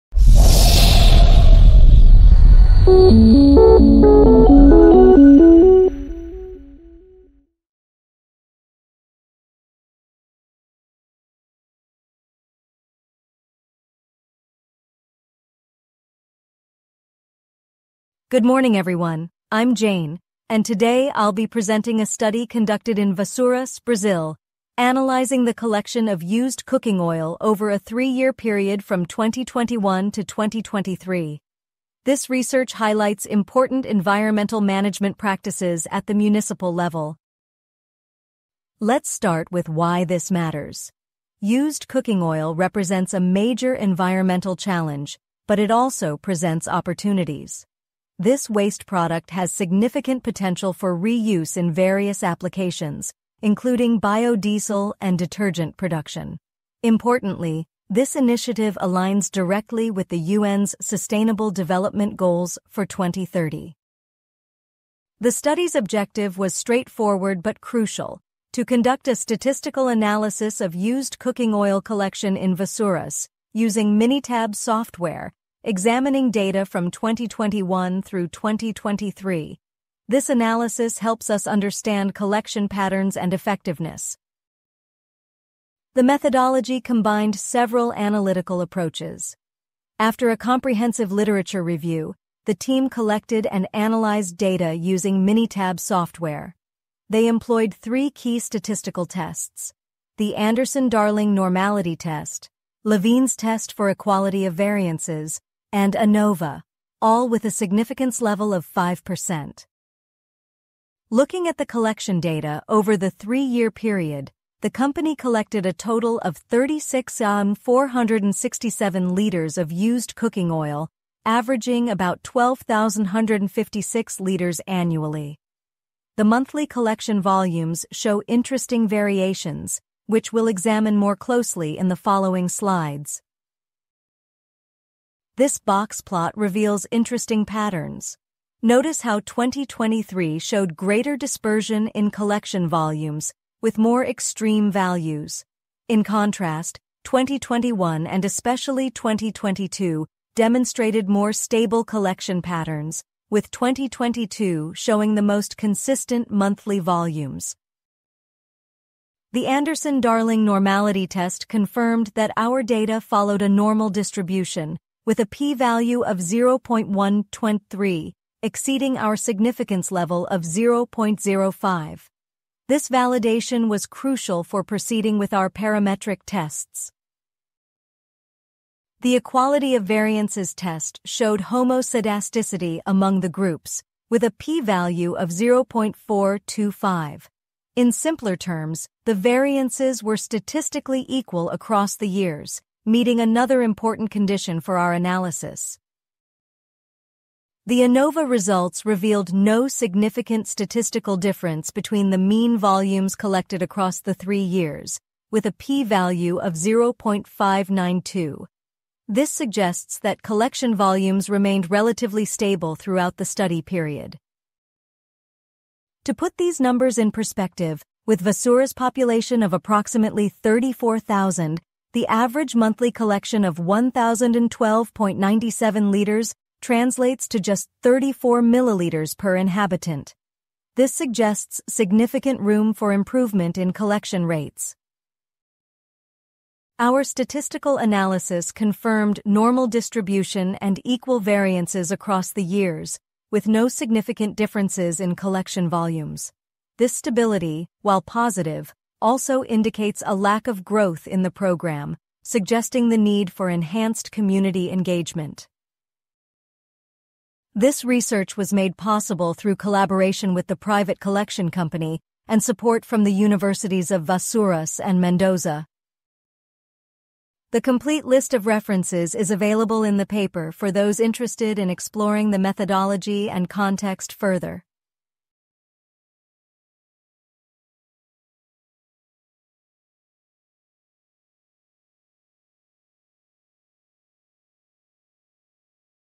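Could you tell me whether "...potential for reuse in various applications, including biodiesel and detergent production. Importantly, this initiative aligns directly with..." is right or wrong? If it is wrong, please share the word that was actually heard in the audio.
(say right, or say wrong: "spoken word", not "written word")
right.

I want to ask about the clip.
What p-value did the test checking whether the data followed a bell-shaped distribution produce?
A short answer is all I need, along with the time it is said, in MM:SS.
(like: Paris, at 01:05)
0.123, at 02:46.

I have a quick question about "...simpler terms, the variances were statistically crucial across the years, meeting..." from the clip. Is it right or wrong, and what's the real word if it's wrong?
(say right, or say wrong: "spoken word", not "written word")
wrong: "equal", not "crucial".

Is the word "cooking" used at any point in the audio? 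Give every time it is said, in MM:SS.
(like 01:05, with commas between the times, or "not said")
00:26, 00:41, 01:11, 02:00.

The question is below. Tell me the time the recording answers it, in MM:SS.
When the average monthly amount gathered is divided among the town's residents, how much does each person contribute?
03:47.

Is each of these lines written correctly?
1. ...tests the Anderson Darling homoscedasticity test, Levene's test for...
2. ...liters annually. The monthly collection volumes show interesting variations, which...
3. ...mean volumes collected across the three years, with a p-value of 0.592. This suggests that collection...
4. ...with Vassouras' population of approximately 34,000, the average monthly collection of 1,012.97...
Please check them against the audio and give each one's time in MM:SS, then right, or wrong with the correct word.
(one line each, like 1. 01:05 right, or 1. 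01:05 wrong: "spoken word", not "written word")
1. 01:39 wrong: "normality", not "homoscedasticity"
2. 02:04 right
3. 03:22 right
4. 03:38 right.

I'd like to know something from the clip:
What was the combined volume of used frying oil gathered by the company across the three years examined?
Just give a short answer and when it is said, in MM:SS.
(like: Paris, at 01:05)
36,467 liters, at 01:56.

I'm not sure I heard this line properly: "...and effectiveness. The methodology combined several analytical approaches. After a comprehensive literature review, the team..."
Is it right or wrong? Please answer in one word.
right.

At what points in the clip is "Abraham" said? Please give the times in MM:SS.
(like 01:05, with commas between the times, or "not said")
not said.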